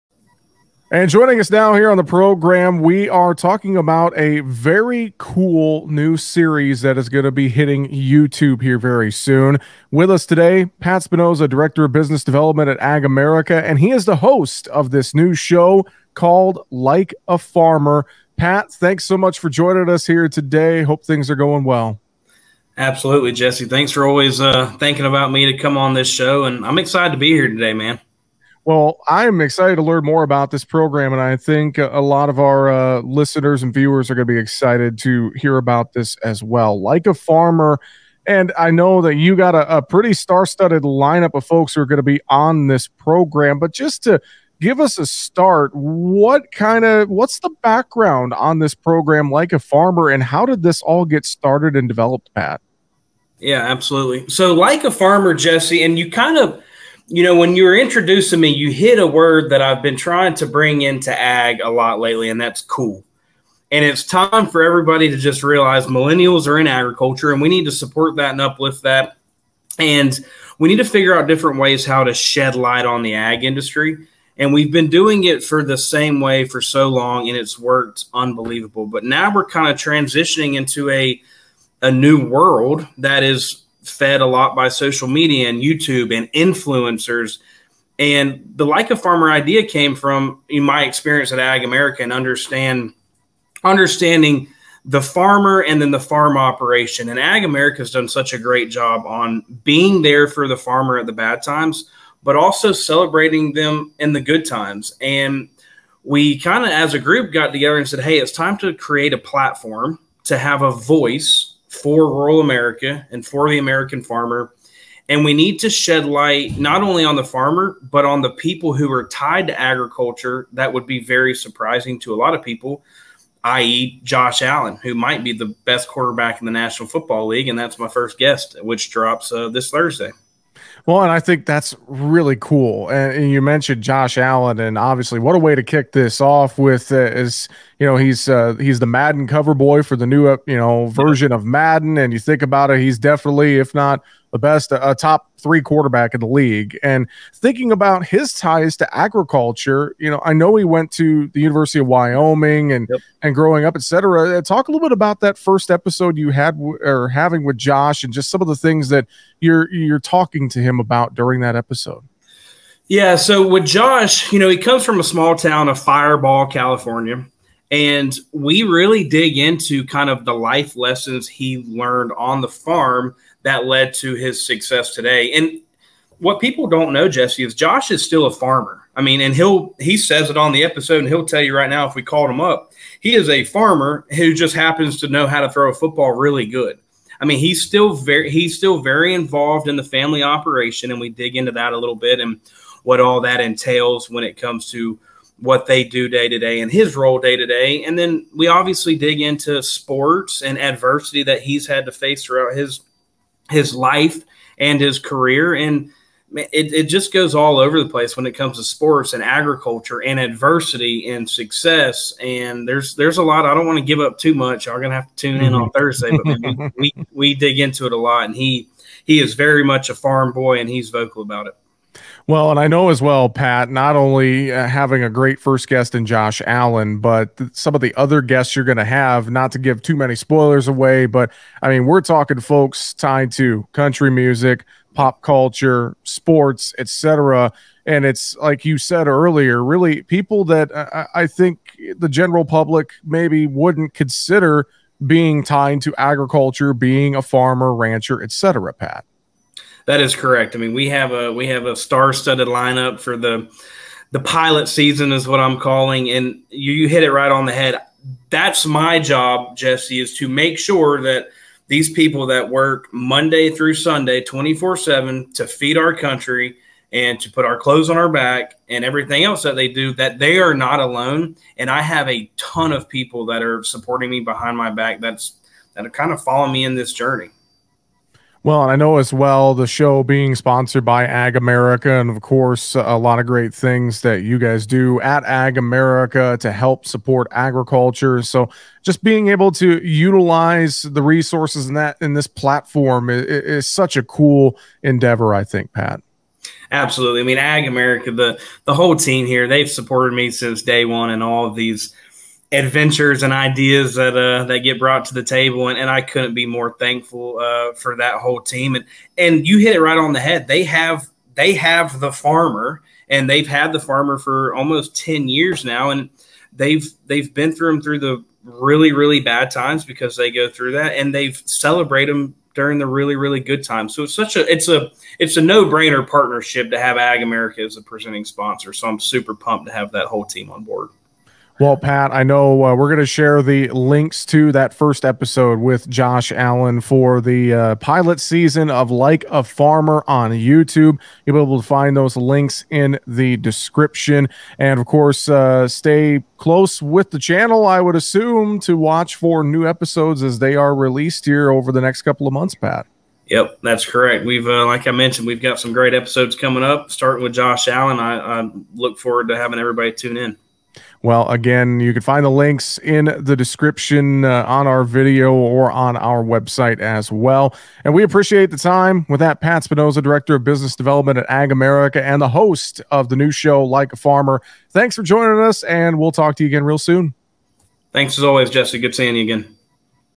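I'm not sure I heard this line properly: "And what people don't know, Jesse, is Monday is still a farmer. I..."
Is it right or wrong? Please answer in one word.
wrong.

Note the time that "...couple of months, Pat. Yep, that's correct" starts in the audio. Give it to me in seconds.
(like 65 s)
352 s.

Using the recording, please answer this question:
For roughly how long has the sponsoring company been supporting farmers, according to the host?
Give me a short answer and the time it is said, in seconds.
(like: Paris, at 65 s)
almost 10 years, at 314 s.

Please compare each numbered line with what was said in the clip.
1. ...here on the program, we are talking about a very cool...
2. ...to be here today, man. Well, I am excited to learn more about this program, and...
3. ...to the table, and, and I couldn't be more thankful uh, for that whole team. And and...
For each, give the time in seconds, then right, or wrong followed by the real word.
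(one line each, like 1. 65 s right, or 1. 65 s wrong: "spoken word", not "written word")
1. 1 s right
2. 27 s right
3. 305 s right.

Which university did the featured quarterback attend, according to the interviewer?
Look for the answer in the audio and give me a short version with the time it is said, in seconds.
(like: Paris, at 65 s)
University of Wyoming, at 151 s.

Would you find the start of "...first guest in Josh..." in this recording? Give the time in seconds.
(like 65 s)
225 s.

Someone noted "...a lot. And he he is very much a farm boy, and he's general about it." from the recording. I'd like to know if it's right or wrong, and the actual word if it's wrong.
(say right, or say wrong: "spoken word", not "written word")
wrong: "vocal", not "general".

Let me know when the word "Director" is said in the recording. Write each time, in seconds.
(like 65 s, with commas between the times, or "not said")
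11 s, 370 s.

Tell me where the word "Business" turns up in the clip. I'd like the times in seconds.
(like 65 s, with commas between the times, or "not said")
11 s, 370 s.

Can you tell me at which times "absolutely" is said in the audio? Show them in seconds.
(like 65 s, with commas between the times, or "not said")
22 s, 53 s, 296 s.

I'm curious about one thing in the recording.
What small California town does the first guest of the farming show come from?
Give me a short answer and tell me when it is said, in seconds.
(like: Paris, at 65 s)
Firebaugh, at 165 s.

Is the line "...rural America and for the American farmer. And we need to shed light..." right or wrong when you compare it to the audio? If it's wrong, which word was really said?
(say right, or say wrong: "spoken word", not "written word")
right.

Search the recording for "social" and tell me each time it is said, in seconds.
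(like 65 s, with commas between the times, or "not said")
84 s.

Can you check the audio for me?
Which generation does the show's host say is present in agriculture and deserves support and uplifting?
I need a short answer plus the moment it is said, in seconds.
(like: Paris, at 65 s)
Millennials, at 65 s.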